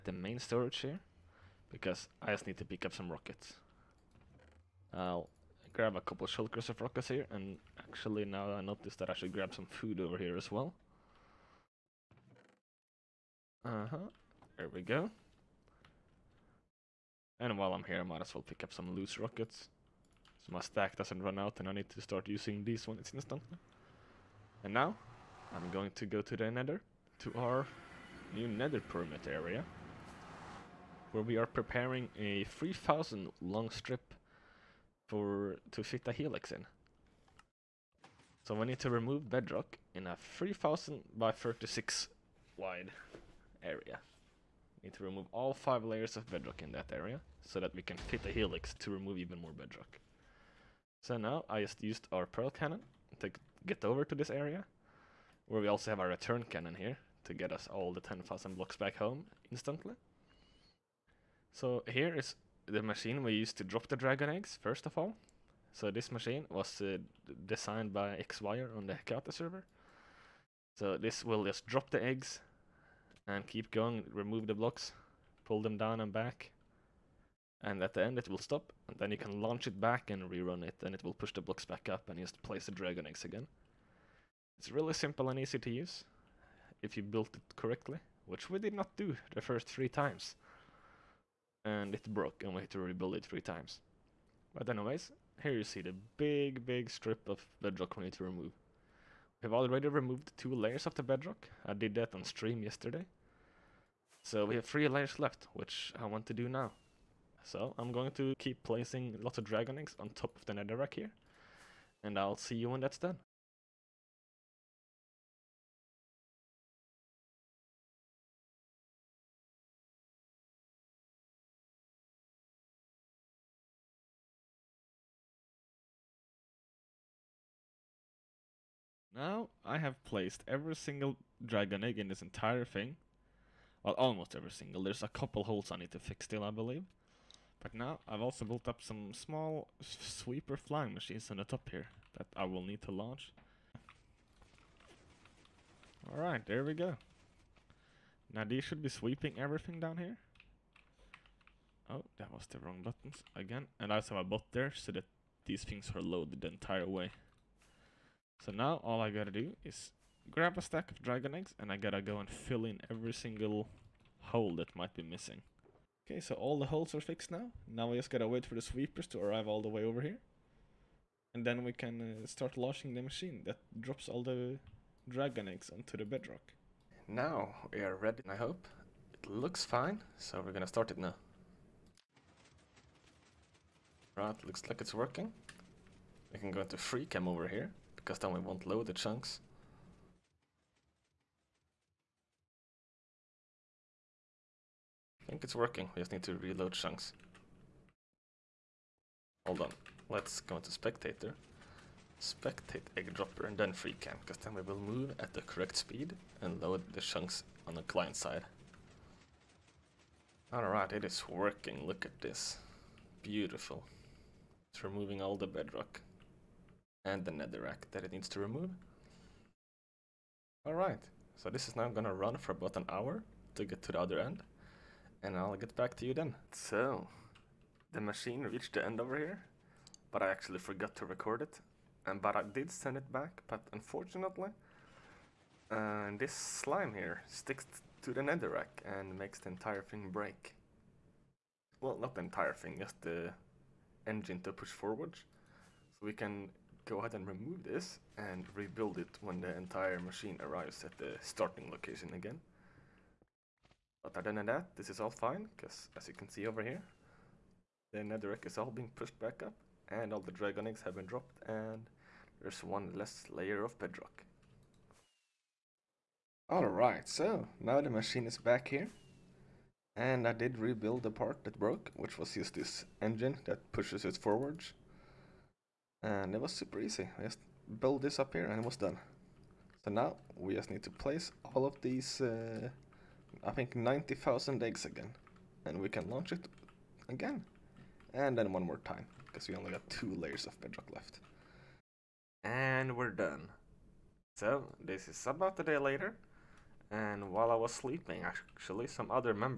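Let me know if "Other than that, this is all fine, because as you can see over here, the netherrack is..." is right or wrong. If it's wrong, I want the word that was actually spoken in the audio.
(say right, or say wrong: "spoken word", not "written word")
right.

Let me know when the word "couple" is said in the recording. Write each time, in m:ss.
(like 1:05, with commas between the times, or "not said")
0:06, 2:15.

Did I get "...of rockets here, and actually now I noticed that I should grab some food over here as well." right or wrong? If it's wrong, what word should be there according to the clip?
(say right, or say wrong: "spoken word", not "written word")
right.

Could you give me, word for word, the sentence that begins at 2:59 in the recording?
It looks fine, so we're gonna start it now.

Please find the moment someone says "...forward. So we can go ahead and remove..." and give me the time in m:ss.
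4:04.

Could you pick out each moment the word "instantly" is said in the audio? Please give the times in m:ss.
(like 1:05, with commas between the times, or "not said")
0:23, 0:59.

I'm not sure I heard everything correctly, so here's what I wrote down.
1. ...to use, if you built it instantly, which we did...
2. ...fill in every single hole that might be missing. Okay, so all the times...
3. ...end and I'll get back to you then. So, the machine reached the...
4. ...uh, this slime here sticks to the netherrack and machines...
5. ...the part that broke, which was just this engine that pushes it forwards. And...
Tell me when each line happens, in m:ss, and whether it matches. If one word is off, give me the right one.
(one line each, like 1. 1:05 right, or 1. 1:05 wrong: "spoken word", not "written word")
1. 1:25 wrong: "correctly", not "instantly"
2. 2:42 wrong: "holes", not "times"
3. 3:44 right
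4. 3:55 wrong: "makes", not "machines"
5. 4:31 right.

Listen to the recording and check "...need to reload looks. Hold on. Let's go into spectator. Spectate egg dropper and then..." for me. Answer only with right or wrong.
wrong.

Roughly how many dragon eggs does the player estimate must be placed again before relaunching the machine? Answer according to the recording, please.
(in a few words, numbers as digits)
90,000.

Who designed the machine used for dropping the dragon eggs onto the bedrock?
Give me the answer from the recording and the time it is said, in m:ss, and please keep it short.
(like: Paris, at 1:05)
Xcom, at 1:08.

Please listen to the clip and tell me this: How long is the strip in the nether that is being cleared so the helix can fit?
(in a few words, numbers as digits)
3000.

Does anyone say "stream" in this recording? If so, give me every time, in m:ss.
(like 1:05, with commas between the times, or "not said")
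1:42.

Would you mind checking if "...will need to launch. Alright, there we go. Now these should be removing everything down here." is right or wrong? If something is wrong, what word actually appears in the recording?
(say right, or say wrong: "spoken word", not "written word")
wrong: "sweeping", not "removing".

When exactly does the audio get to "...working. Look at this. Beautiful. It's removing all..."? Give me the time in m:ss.
3:31.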